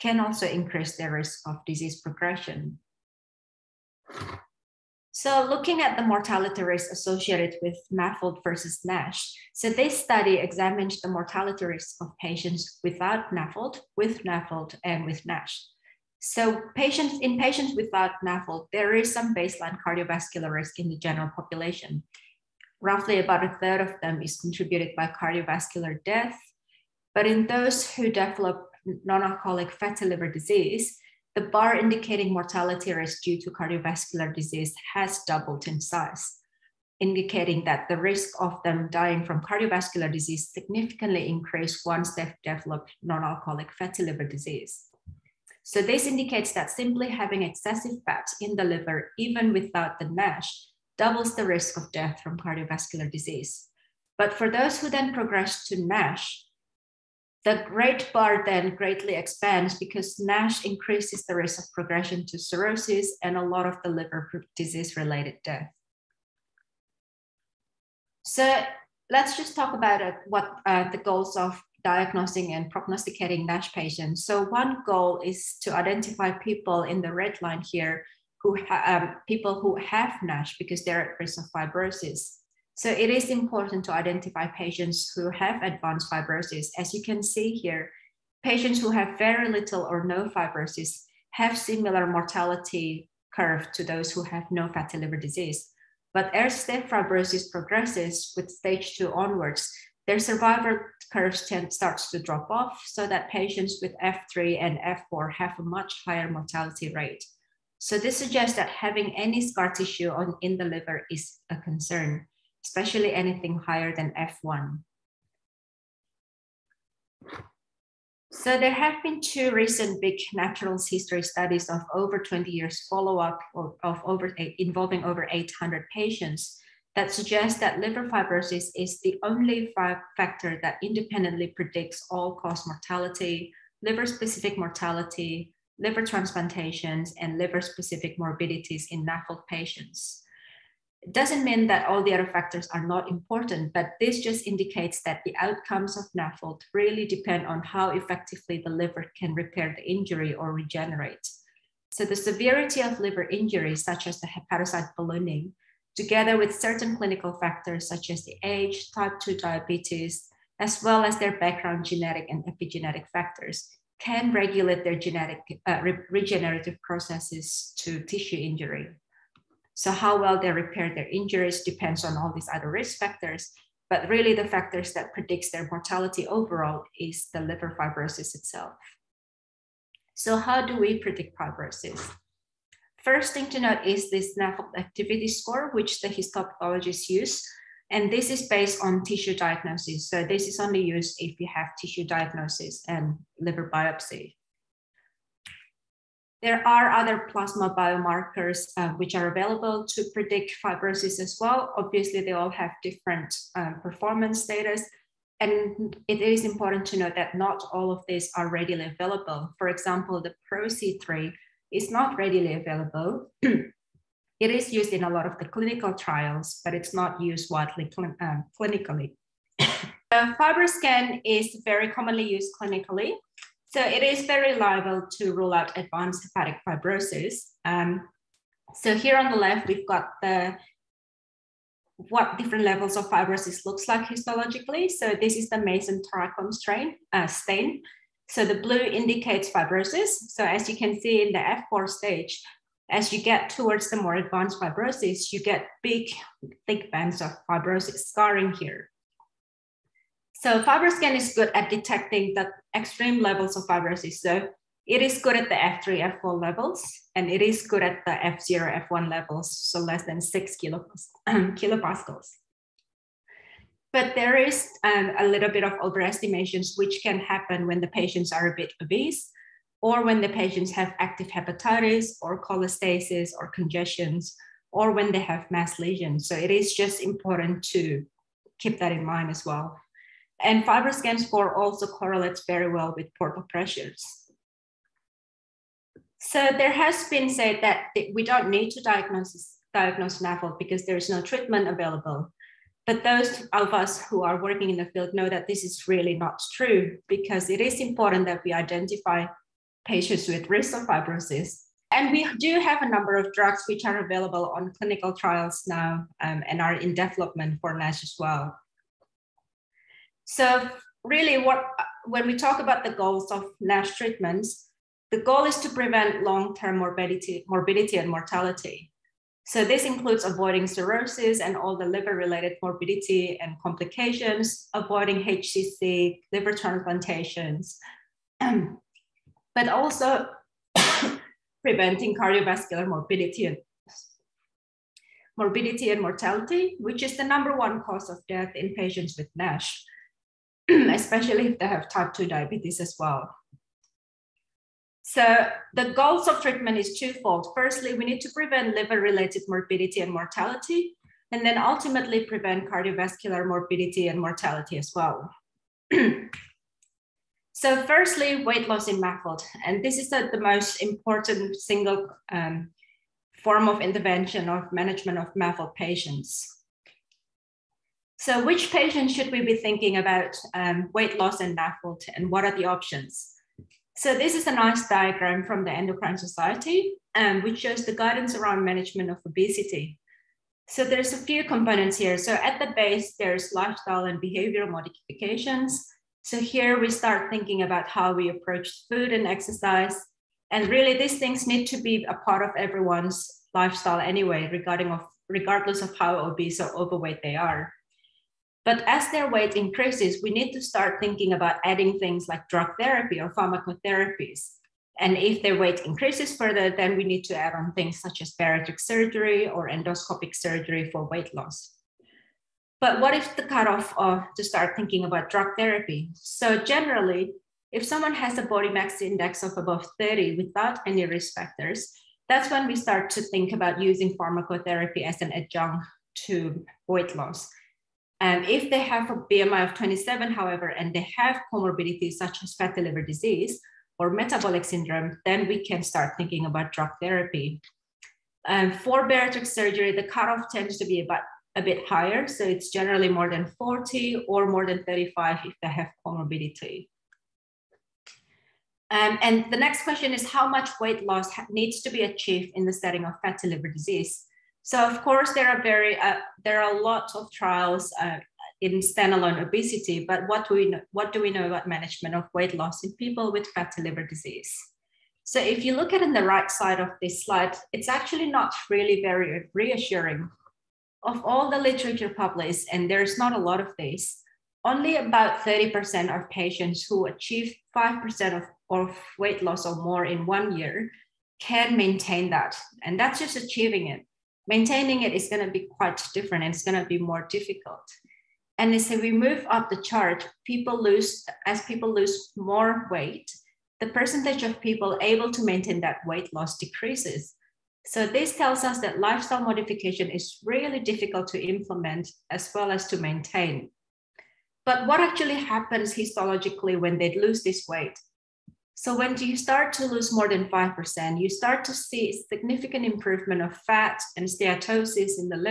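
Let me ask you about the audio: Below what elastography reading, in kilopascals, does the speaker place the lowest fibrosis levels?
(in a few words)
6.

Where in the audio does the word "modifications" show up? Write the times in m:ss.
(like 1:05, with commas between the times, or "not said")
6:24, 8:19.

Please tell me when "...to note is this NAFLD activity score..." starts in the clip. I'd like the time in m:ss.
3:03.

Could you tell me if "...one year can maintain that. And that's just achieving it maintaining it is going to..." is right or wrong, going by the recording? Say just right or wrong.
right.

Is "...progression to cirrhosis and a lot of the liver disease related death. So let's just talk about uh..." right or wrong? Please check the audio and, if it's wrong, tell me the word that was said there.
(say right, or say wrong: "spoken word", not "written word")
right.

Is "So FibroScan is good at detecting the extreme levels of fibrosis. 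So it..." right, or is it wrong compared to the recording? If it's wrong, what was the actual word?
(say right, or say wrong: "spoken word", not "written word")
right.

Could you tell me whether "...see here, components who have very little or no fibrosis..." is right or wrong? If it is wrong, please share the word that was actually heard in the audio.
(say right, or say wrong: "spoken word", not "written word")
wrong: "patients", not "components".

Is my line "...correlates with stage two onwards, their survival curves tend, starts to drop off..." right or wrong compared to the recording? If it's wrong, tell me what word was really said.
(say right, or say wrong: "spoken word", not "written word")
wrong: "progresses", not "correlates".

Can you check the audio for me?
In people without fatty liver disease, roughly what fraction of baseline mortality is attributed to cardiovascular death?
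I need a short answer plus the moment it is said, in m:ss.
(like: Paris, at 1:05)
a third, at 0:23.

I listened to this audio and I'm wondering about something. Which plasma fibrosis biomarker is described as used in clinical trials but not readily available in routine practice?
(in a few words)
PRO-C3.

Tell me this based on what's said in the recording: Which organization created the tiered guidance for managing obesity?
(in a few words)
Endocrine Society.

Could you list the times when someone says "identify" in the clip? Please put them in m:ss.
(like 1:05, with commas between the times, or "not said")
1:15, 1:23, 4:58.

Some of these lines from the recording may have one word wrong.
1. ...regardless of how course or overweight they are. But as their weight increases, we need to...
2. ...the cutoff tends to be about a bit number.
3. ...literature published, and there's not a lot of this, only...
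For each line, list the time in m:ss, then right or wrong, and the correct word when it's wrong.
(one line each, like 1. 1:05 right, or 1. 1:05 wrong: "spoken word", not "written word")
1. 6:35 wrong: "obese", not "course"
2. 7:19 wrong: "higher", not "number"
3. 7:51 right.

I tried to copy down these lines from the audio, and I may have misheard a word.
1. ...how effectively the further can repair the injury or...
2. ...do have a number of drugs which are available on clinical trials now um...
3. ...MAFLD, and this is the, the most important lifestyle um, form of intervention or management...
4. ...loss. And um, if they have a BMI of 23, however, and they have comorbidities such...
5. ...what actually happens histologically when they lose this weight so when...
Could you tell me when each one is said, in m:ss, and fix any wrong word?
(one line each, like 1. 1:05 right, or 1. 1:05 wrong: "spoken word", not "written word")
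1. 2:27 wrong: "liver", not "further"
2. 5:02 right
3. 5:58 wrong: "single", not "lifestyle"
4. 7:07 wrong: "27", not "23"
5. 8:24 right.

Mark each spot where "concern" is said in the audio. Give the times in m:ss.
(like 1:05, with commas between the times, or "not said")
1:51.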